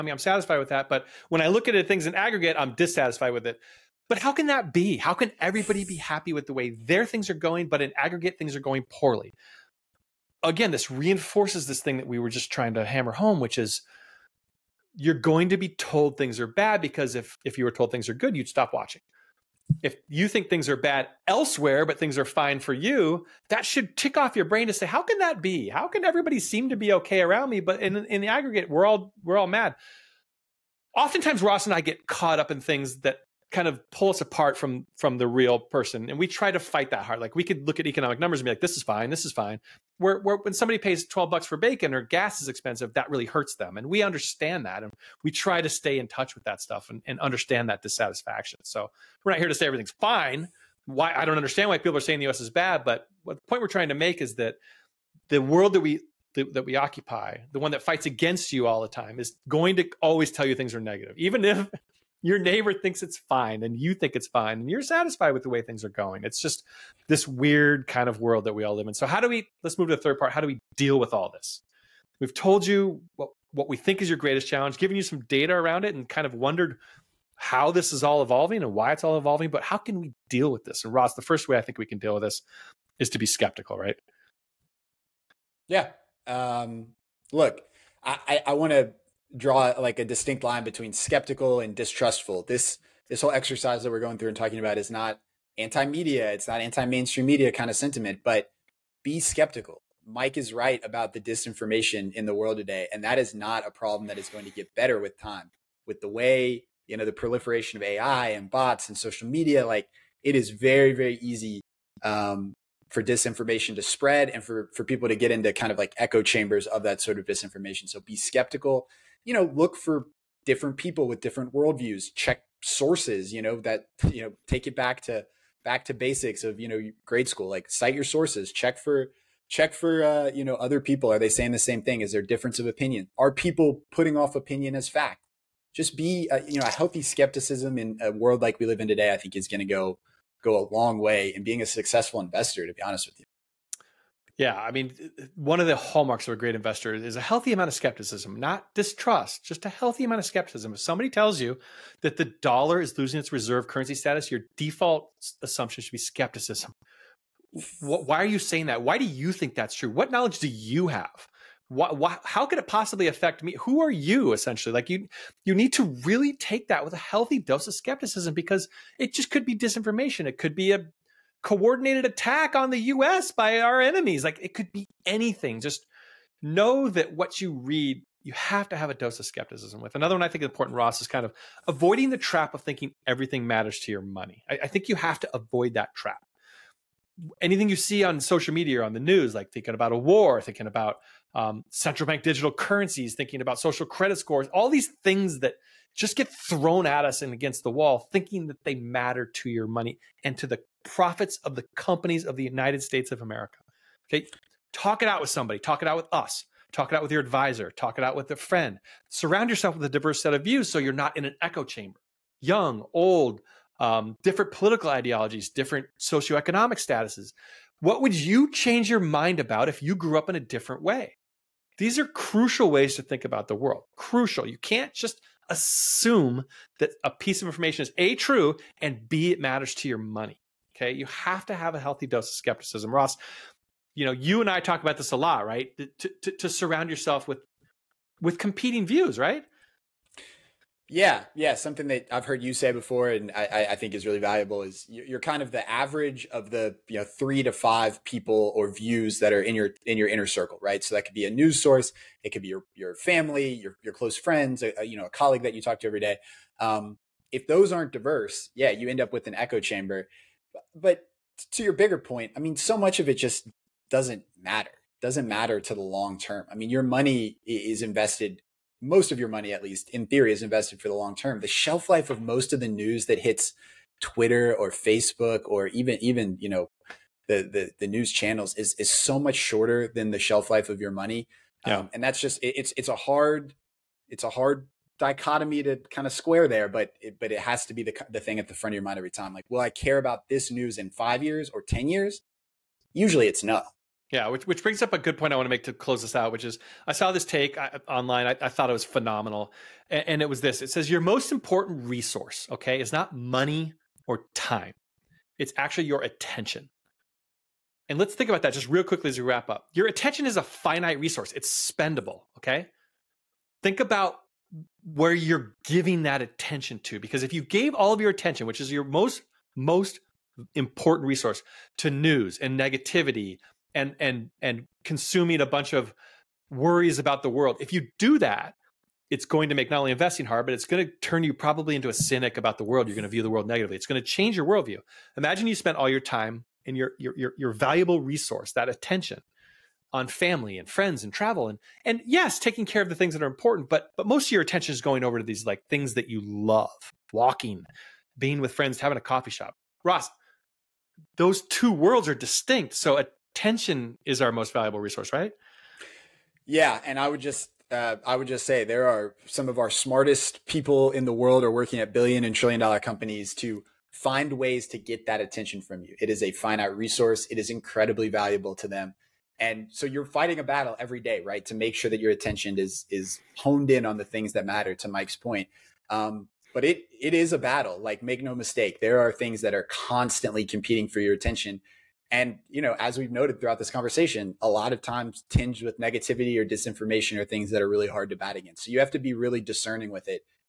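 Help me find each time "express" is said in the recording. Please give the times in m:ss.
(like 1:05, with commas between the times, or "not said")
not said.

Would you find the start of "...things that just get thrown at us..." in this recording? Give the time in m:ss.
3:15.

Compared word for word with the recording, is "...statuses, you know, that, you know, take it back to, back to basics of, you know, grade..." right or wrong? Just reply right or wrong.
wrong.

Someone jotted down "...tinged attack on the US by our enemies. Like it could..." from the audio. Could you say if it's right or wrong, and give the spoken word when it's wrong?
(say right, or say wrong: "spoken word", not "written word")
wrong: "coordinated", not "tinged".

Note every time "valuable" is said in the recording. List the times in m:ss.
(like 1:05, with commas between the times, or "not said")
4:04, 5:37, 5:54, 6:08.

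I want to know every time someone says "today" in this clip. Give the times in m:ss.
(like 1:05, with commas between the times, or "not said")
1:42, 2:18.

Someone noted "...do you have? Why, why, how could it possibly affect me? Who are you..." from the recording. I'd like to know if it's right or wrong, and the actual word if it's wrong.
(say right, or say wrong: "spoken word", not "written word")
right.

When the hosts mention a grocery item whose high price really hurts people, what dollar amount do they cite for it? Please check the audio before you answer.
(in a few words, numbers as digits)
$12.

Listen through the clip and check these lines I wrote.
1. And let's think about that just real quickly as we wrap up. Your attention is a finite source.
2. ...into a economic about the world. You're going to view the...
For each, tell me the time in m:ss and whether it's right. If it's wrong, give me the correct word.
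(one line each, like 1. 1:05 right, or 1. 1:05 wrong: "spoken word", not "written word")
1. 5:07 wrong: "resource", not "source"
2. 5:31 wrong: "cynic", not "economic".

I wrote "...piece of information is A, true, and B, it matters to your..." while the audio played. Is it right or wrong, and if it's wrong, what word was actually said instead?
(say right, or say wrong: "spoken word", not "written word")
right.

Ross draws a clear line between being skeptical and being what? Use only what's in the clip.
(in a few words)
distrustful.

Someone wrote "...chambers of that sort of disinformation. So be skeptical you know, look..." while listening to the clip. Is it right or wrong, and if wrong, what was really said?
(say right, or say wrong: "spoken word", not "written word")
right.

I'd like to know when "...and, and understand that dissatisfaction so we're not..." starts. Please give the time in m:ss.
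0:46.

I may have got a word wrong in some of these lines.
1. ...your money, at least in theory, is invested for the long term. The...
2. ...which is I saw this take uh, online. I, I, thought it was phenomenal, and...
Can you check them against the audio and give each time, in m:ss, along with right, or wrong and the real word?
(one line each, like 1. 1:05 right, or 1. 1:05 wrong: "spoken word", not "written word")
1. 4:29 right
2. 4:56 right.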